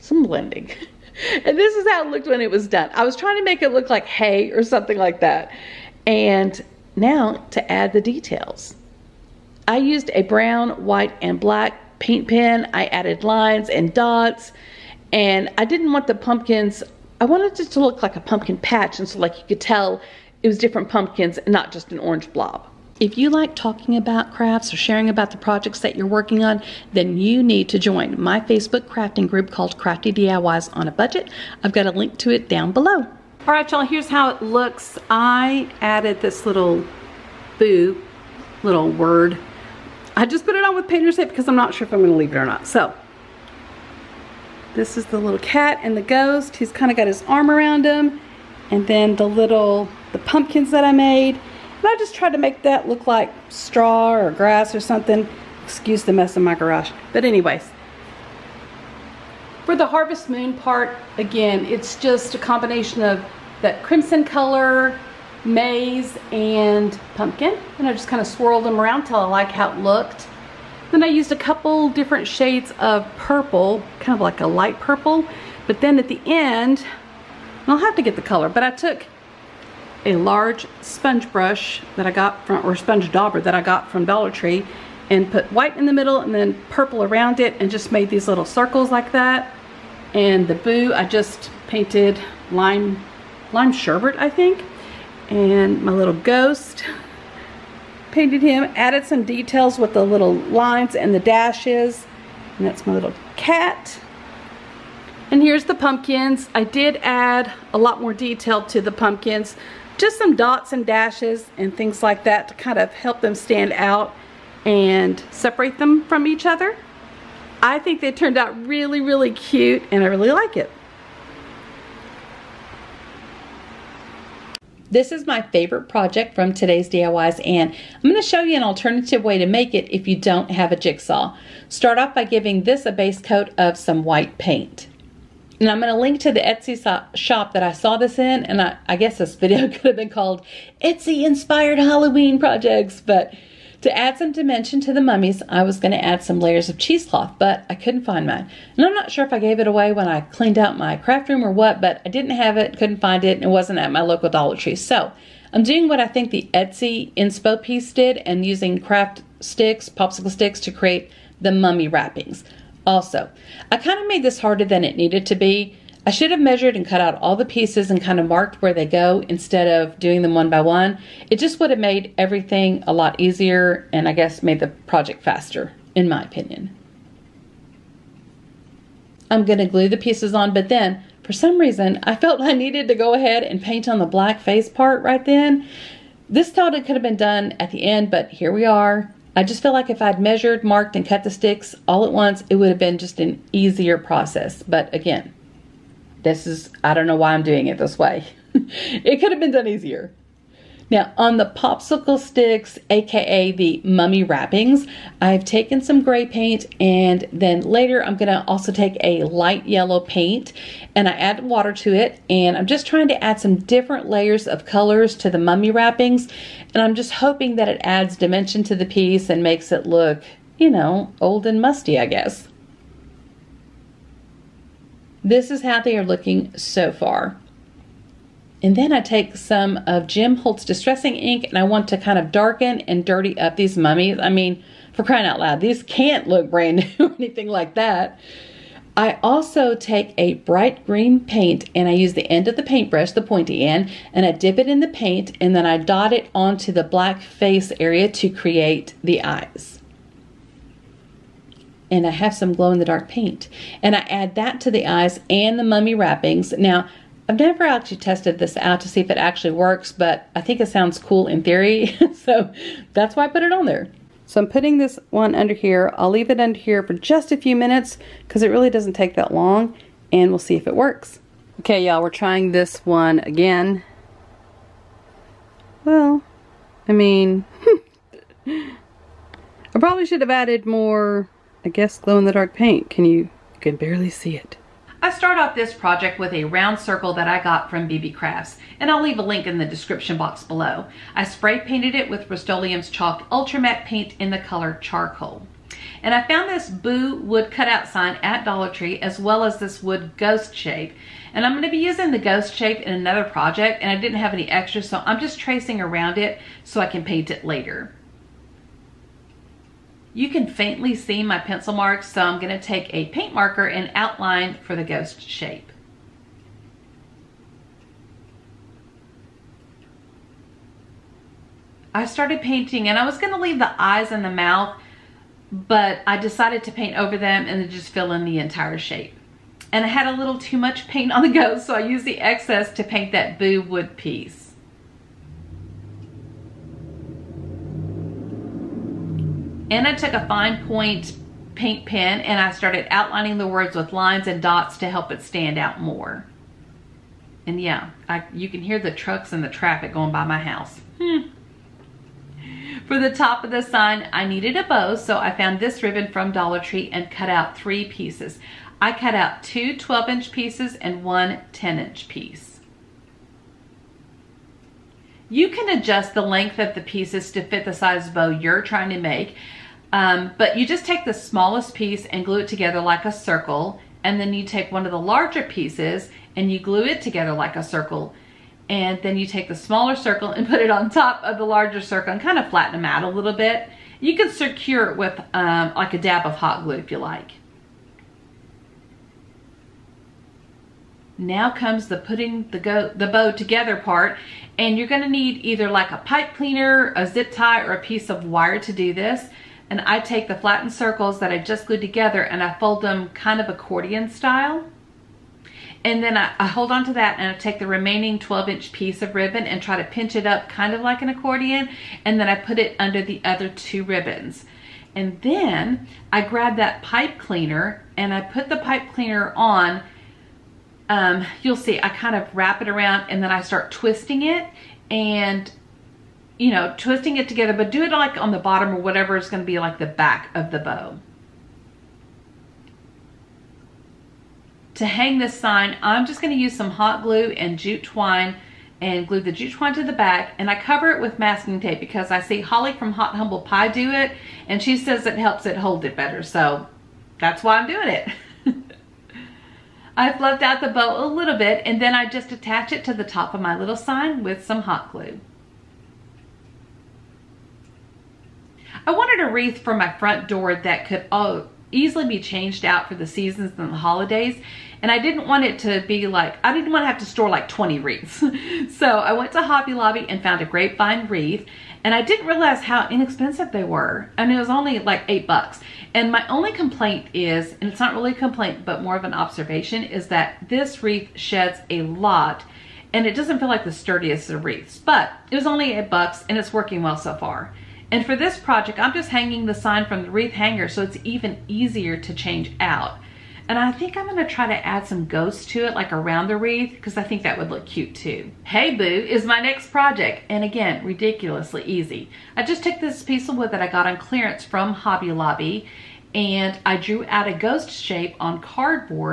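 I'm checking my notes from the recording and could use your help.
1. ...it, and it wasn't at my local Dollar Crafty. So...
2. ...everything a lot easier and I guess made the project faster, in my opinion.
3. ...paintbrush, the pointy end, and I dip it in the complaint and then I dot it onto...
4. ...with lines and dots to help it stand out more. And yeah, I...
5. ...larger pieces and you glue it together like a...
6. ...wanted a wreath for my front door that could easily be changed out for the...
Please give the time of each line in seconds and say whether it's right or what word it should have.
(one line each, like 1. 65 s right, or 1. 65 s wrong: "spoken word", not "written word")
1. 153 s wrong: "Tree", not "Crafty"
2. 172 s right
3. 242 s wrong: "paint", not "complaint"
4. 343 s right
5. 374 s right
6. 458 s right.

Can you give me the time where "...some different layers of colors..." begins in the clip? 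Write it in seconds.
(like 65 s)
213 s.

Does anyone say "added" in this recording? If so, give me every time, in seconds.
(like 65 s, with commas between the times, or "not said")
12 s, 35 s, 98 s, 280 s.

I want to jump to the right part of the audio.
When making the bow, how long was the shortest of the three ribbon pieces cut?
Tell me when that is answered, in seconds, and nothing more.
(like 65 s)
361 s.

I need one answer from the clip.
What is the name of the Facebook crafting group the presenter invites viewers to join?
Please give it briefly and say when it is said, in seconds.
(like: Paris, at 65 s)
Crafty DIYs on a Budget, at 29 s.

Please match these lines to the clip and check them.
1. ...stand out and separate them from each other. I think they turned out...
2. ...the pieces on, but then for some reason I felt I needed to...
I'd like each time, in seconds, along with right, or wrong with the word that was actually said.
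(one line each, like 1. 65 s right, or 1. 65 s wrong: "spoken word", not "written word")
1. 113 s right
2. 179 s right.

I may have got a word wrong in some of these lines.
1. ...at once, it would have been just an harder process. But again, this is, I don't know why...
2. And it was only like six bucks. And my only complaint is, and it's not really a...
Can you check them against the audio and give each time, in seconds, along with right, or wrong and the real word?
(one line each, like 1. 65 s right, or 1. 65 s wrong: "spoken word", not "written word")
1. 192 s wrong: "easier", not "harder"
2. 474 s wrong: "eight", not "six".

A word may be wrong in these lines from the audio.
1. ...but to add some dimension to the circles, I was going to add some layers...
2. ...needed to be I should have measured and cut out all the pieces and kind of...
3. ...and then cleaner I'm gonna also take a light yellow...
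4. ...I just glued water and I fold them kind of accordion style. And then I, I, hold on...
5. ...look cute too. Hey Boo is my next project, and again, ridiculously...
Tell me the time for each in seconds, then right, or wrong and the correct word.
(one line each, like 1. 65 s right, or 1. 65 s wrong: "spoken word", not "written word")
1. 143 s wrong: "mummies", not "circles"
2. 164 s right
3. 206 s wrong: "later", not "cleaner"
4. 401 s wrong: "together", not "water"
5. 497 s right.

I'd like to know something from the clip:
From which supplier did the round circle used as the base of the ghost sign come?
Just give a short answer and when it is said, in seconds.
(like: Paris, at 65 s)
BB Crafts, at 287 s.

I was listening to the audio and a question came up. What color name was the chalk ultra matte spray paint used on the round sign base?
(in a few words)
Charcoal.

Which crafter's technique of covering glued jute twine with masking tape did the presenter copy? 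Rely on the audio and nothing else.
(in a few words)
Holly from Hot Humble Pie.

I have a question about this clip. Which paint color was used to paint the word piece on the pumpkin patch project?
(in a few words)
lime sherbet.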